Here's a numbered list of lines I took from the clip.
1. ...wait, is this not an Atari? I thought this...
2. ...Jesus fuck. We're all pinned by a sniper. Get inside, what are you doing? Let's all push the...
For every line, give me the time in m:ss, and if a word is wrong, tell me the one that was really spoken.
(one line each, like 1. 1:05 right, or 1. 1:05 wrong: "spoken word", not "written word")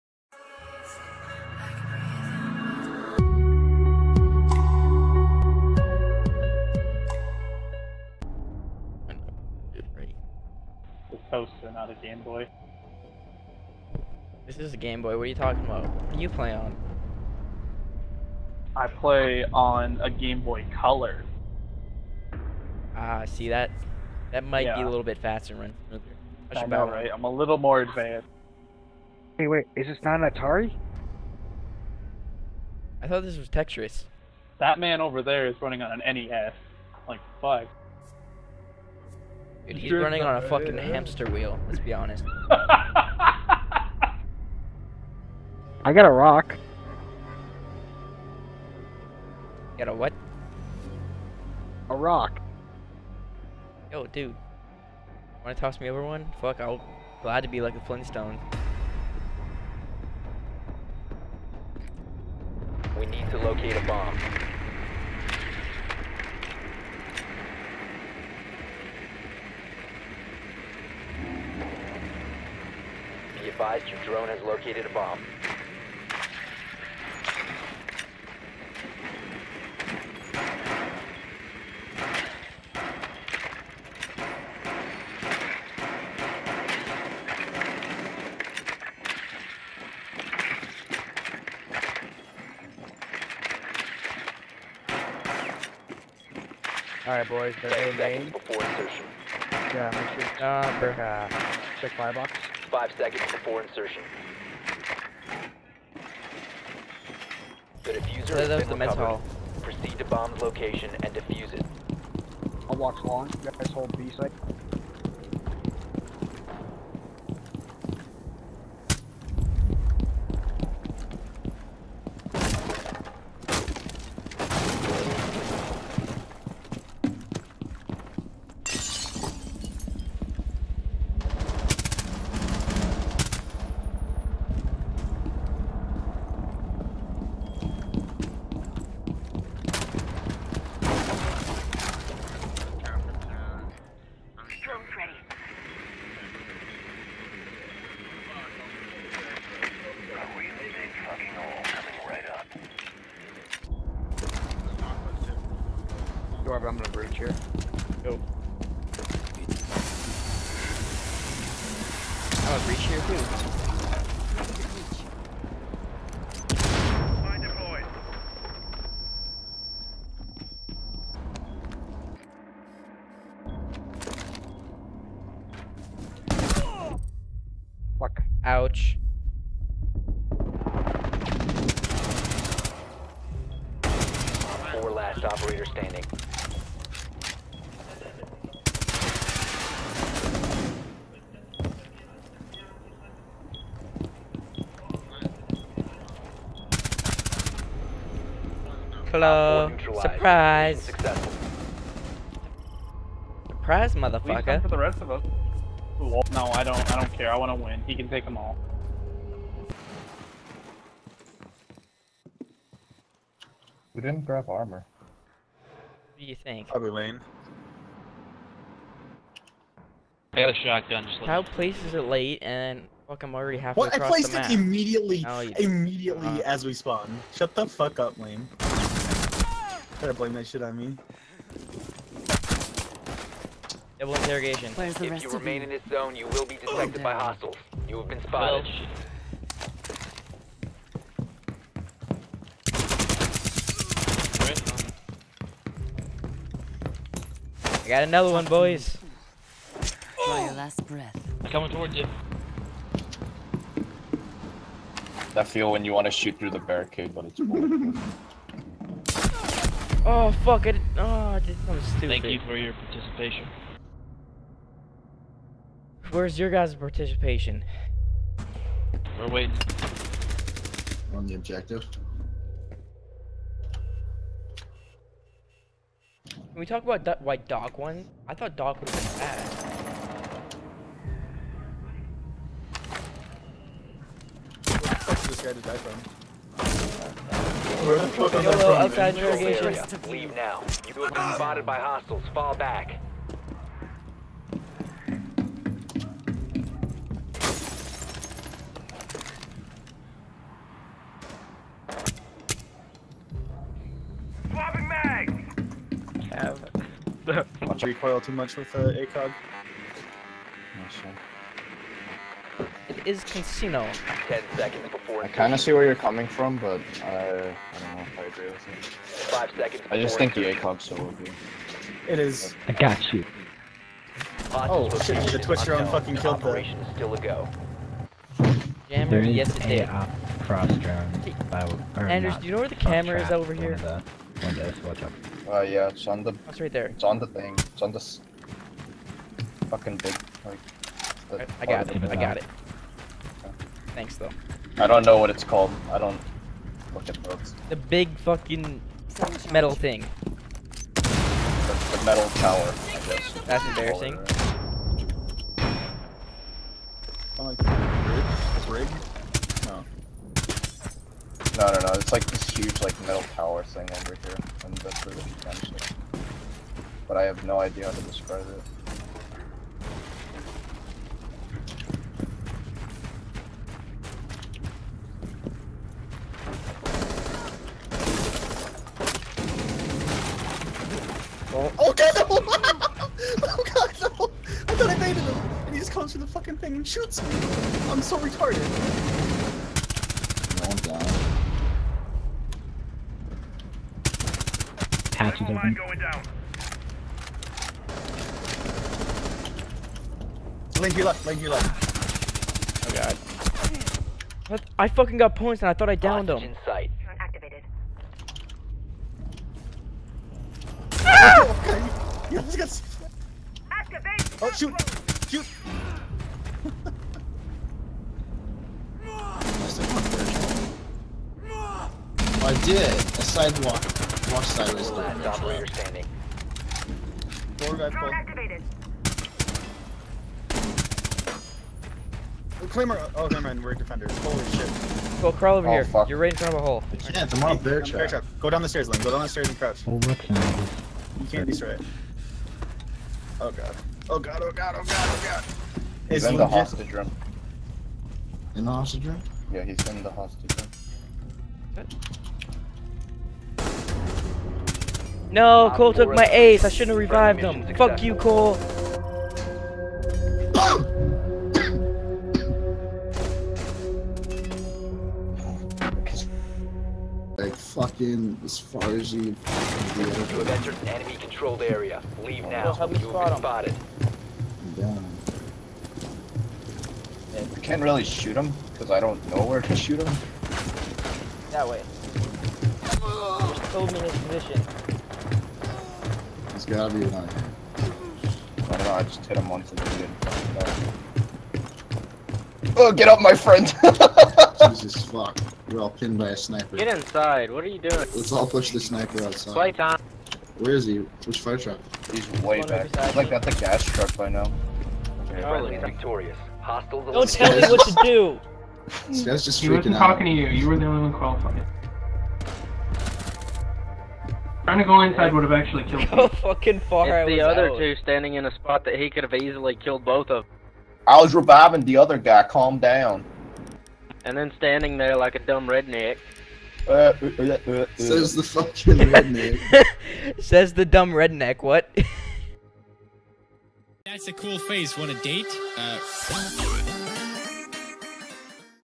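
1. 0:29 right
2. 8:14 right.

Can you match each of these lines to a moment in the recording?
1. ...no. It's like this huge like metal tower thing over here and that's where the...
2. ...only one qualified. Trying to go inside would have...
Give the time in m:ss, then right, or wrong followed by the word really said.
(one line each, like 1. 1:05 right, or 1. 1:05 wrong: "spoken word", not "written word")
1. 6:01 right
2. 8:30 right.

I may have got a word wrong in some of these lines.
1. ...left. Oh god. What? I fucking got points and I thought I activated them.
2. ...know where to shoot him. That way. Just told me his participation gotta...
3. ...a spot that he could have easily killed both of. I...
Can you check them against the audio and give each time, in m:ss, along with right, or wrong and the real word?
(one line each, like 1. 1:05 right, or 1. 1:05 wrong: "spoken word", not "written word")
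1. 6:41 wrong: "downed", not "activated"
2. 7:59 wrong: "position", not "participation"
3. 8:38 right.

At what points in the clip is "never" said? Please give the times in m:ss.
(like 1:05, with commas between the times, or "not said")
7:13.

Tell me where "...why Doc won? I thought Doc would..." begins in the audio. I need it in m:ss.
4:37.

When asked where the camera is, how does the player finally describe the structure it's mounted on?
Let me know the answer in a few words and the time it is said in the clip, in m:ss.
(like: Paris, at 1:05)
The metal tower, at 5:51.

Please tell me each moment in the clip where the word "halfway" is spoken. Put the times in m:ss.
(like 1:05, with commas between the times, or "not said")
3:43.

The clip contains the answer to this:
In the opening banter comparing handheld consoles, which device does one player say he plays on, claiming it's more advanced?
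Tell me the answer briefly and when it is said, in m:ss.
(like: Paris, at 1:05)
Game Boy Color, at 0:20.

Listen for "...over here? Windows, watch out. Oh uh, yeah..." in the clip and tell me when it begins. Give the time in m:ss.
5:33.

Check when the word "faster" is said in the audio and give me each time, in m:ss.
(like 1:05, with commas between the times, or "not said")
0:25.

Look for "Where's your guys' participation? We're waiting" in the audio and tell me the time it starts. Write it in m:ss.
4:26.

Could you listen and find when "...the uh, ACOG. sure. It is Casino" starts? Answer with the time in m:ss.
5:08.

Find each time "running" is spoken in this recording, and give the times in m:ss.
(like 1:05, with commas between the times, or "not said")
0:35, 0:39.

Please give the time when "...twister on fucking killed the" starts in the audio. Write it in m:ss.
5:25.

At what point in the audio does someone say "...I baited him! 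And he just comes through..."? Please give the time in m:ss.
6:24.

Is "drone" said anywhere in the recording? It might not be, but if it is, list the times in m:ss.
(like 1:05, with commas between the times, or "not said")
1:14, 5:30.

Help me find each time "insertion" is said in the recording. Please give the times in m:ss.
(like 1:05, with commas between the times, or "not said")
1:38, 1:43.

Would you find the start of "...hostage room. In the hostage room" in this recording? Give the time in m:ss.
7:26.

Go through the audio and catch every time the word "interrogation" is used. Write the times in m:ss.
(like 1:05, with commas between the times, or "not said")
3:54, 4:49.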